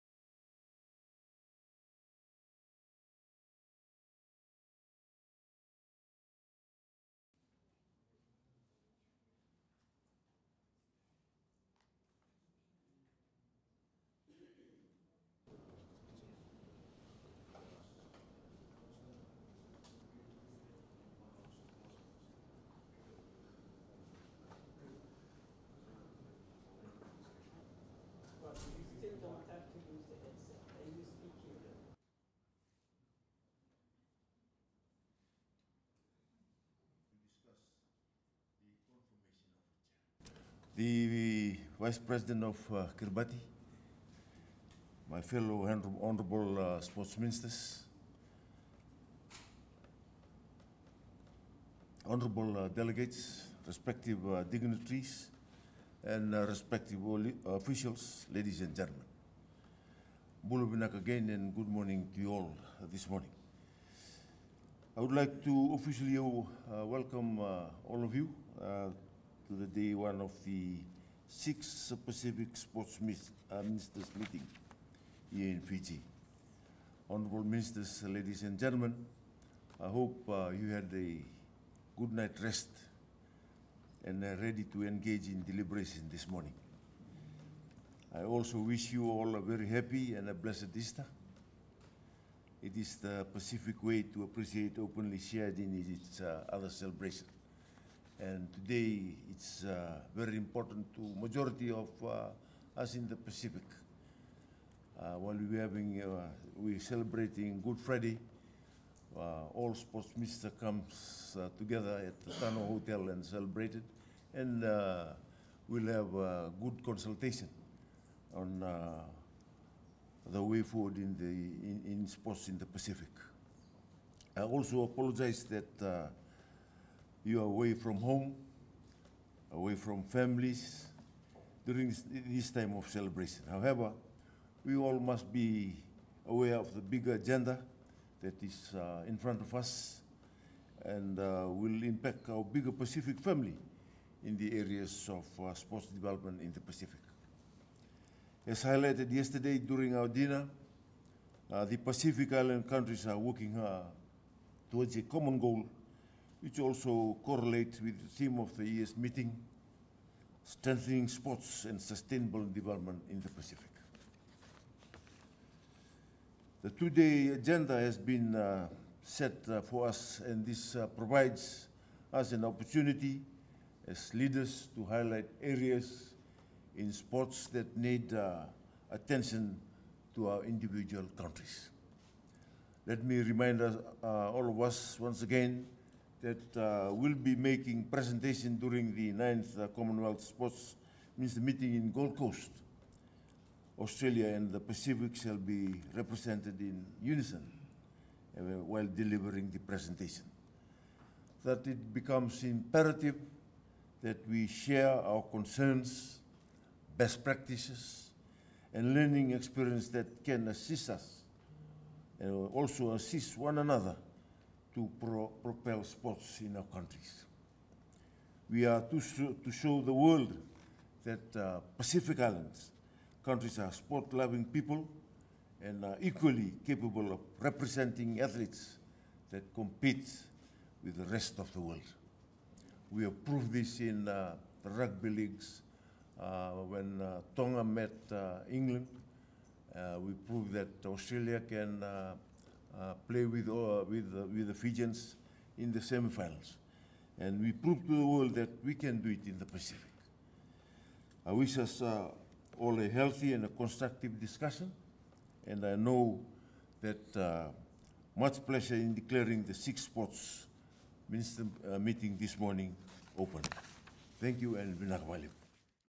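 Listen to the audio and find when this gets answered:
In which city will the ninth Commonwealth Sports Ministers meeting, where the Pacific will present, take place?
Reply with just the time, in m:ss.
3:11.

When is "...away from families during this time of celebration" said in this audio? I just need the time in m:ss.
2:09.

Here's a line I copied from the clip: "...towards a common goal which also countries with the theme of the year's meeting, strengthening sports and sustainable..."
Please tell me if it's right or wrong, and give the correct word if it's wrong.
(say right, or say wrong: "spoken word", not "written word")
wrong: "correlates", not "countries".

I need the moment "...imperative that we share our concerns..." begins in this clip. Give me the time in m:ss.
3:22.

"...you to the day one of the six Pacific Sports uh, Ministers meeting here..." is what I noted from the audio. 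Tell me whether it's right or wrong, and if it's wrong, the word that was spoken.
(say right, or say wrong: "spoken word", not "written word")
right.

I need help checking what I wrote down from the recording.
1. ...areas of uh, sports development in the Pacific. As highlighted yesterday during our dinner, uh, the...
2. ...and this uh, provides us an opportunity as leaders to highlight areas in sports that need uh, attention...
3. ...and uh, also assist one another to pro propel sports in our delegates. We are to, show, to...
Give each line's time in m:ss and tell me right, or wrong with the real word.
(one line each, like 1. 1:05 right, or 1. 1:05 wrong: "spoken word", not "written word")
1. 2:24 right
2. 2:50 right
3. 3:32 wrong: "countries", not "delegates".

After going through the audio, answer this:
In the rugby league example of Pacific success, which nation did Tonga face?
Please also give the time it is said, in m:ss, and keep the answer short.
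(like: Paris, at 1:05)
England, at 3:58.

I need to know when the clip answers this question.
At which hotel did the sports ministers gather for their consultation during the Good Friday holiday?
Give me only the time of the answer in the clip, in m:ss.
1:52.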